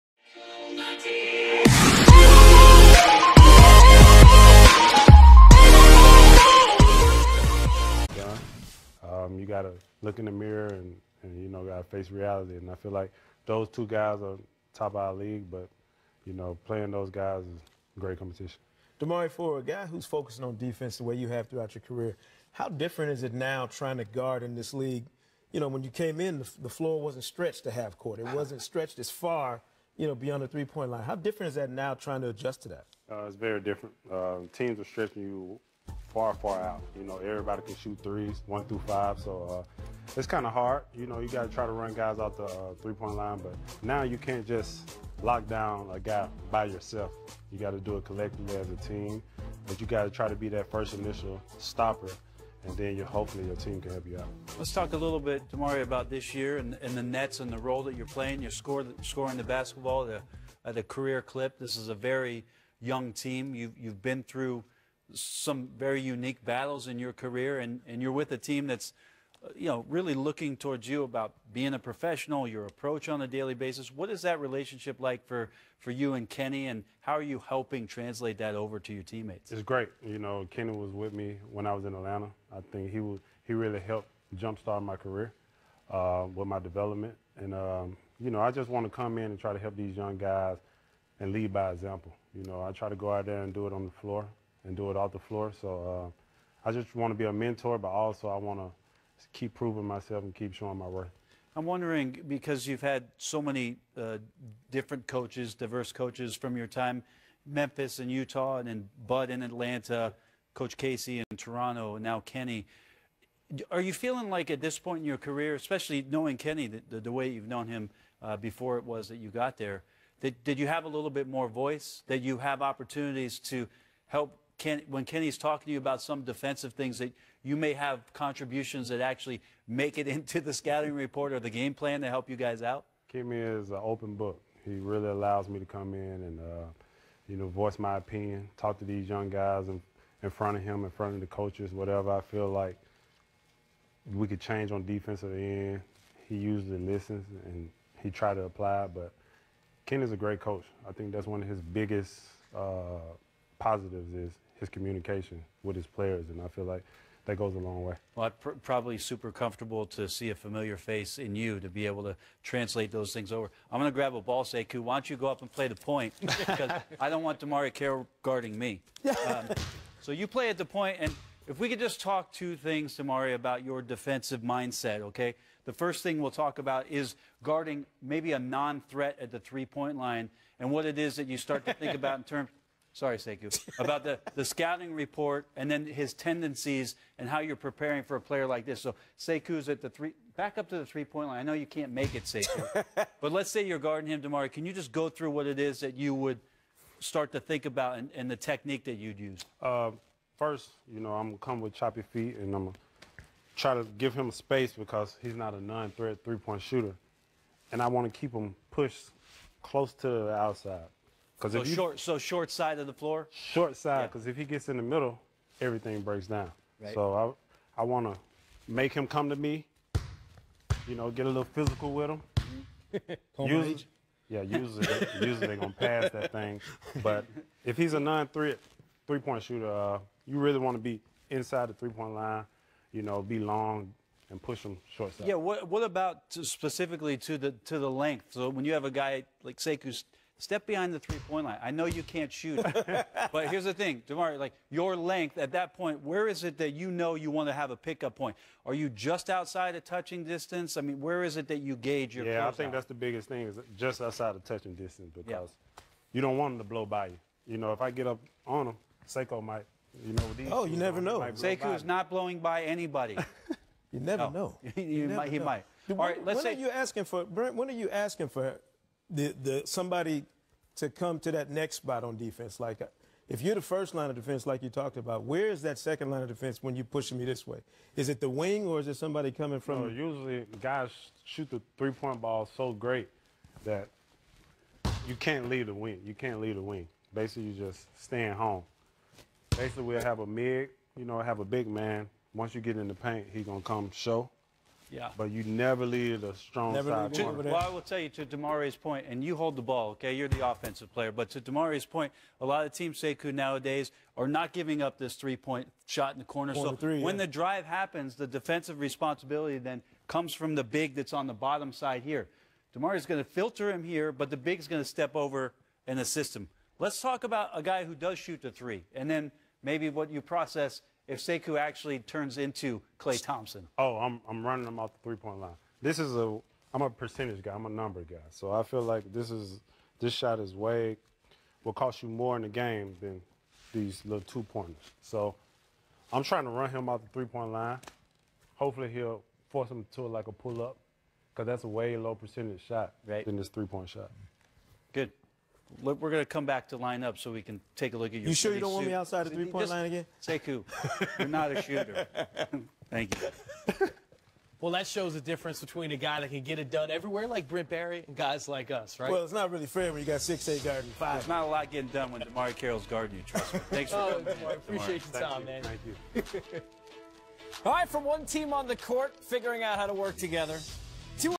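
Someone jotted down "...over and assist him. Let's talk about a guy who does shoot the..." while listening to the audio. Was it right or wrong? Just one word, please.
right.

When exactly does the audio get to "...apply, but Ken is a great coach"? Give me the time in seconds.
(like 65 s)
148 s.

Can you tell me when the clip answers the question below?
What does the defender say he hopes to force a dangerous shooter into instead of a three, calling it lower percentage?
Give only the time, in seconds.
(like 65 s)
340 s.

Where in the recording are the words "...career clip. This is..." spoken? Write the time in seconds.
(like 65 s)
60 s.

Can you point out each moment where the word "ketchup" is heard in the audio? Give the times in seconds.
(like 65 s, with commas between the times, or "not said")
not said.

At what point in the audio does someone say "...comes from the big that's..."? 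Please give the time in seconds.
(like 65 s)
310 s.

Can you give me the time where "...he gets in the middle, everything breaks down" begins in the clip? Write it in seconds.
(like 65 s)
214 s.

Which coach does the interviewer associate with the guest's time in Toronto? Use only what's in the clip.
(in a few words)
Coach Casey.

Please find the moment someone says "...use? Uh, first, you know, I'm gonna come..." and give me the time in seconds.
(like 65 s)
199 s.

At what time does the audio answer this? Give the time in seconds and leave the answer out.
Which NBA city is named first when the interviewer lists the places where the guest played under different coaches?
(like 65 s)
107 s.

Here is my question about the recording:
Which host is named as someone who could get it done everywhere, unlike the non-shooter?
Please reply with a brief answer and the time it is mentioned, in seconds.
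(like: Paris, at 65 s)
Brent Barry, at 357 s.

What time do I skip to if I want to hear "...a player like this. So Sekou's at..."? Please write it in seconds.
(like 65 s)
188 s.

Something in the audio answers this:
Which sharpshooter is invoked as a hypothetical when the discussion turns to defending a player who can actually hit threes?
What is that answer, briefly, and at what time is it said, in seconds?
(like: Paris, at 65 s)
Klay Thompson, at 322 s.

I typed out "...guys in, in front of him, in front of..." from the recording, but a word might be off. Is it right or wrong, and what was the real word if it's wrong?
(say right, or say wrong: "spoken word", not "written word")
right.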